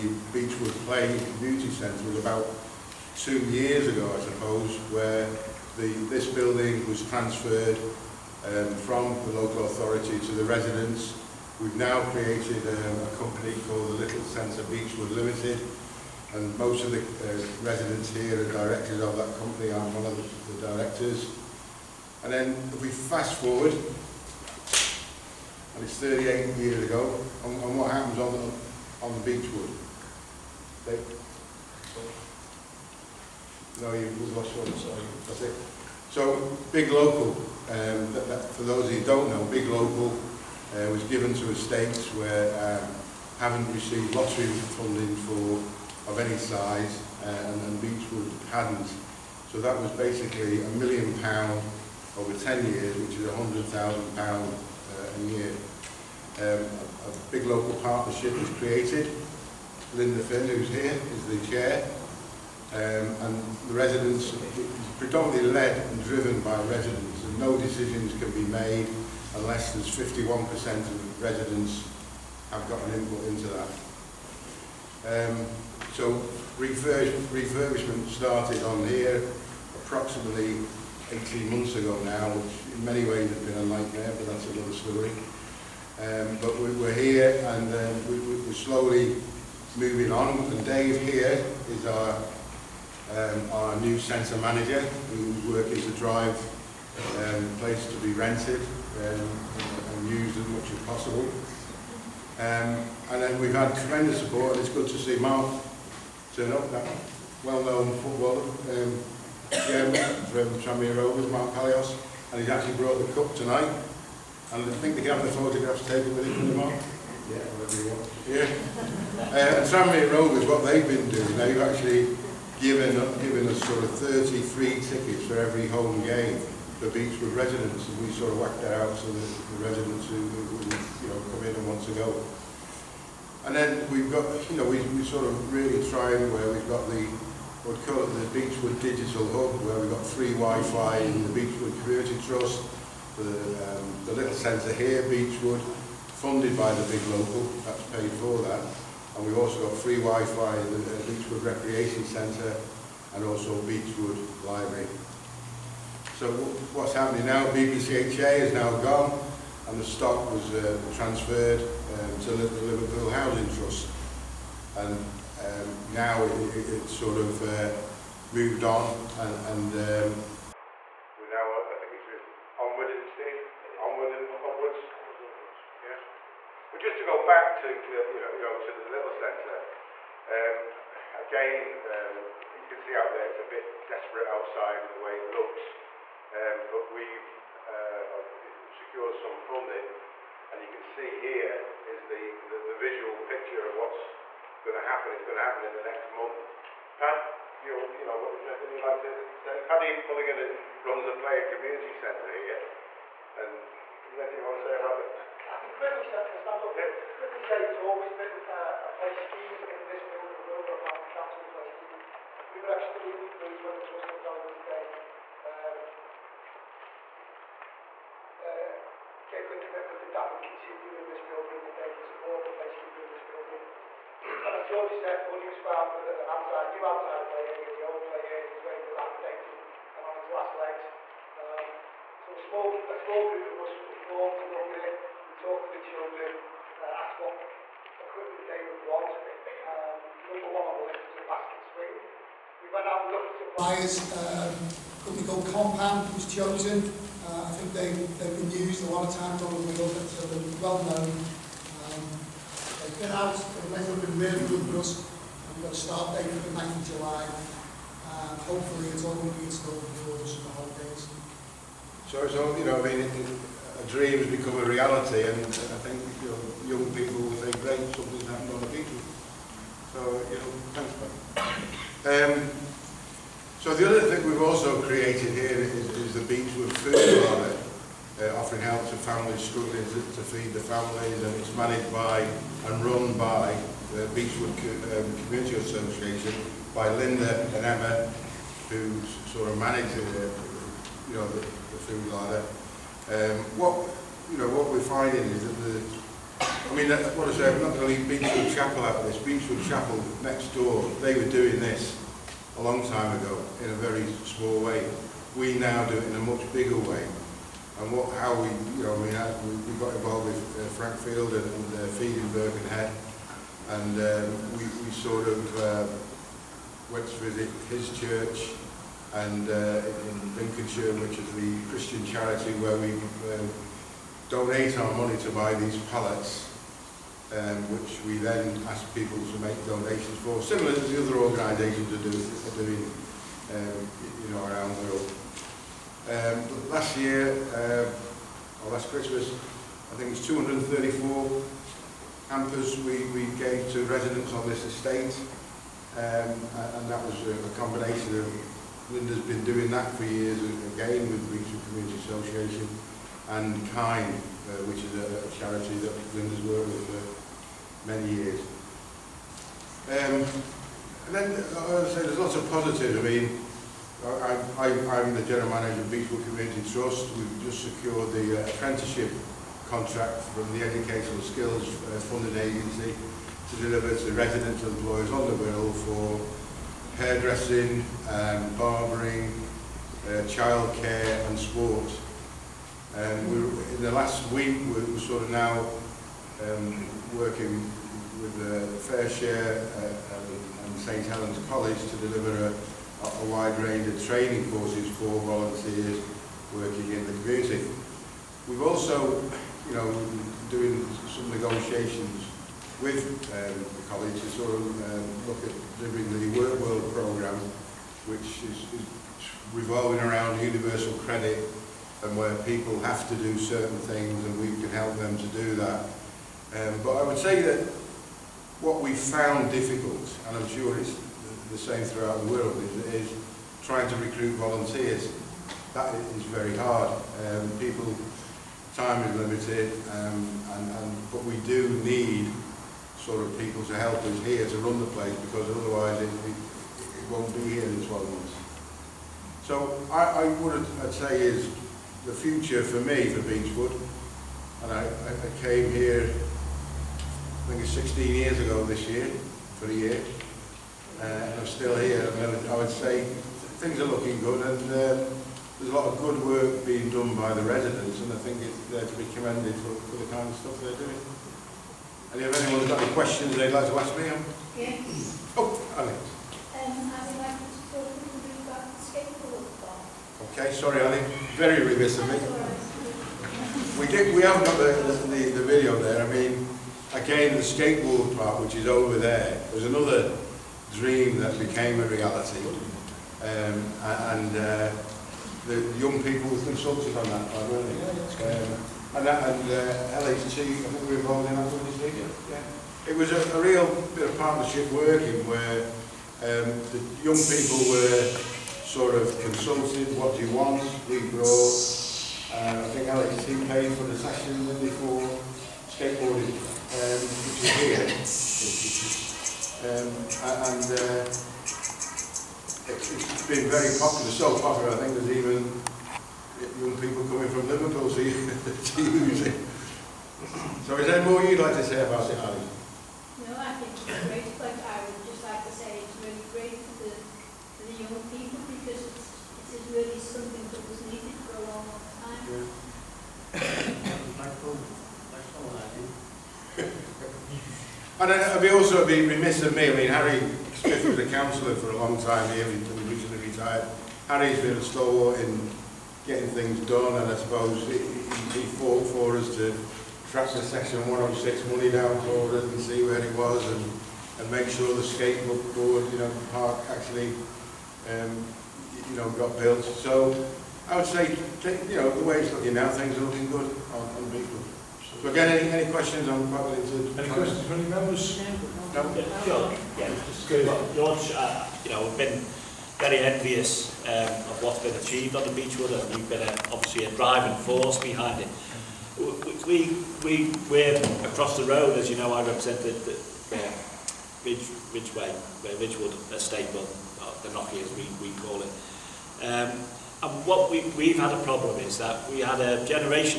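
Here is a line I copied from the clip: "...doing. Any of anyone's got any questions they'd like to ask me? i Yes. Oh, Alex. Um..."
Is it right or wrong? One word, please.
right.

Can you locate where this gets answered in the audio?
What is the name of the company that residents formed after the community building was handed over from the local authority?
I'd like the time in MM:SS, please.
00:14.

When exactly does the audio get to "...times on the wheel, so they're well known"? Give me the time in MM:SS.
04:09.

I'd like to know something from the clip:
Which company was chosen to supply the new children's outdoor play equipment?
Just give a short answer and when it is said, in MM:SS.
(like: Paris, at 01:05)
Compound, at 04:05.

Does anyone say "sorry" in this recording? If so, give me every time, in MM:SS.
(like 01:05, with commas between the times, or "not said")
00:34, 07:50.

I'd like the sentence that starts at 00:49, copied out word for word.
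So that was basically a million pound over 10 years, which is £100,000 uh, a year.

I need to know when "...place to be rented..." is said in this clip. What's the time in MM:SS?
01:37.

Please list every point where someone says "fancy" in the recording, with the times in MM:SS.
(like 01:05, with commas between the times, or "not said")
not said.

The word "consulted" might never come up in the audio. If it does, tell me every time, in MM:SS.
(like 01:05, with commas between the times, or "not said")
08:06, 08:19.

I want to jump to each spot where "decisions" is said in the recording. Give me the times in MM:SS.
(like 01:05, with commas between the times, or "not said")
01:07.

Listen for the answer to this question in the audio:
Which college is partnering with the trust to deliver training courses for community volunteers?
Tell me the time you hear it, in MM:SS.
06:30.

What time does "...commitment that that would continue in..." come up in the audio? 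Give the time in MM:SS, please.
03:39.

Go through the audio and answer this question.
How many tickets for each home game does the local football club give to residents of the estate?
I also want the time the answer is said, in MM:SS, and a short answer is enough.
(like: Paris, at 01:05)
33, at 02:03.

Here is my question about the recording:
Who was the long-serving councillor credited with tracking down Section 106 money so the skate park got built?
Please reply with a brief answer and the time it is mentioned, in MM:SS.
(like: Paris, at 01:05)
Harry Smith, at 08:59.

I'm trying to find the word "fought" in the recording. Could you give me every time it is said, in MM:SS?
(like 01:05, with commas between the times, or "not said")
09:08.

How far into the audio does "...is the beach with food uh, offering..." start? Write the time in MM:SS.
04:35.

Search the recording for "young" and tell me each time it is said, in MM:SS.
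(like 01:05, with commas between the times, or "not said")
04:26, 08:05, 08:17, 08:36, 08:47.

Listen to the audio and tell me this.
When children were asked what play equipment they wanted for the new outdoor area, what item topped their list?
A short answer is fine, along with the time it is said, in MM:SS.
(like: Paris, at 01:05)
A basket swing, at 04:01.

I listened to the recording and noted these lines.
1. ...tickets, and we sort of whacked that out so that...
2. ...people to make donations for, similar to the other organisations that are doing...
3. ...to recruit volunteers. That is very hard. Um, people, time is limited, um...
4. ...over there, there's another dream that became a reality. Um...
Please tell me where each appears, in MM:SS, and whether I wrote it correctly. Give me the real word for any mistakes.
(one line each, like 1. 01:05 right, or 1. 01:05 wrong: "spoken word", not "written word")
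1. 02:07 wrong: "residents", not "tickets"
2. 05:28 right
3. 07:03 right
4. 07:58 right.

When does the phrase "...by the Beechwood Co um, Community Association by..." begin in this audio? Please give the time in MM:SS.
04:43.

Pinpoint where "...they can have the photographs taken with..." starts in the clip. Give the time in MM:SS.
01:54.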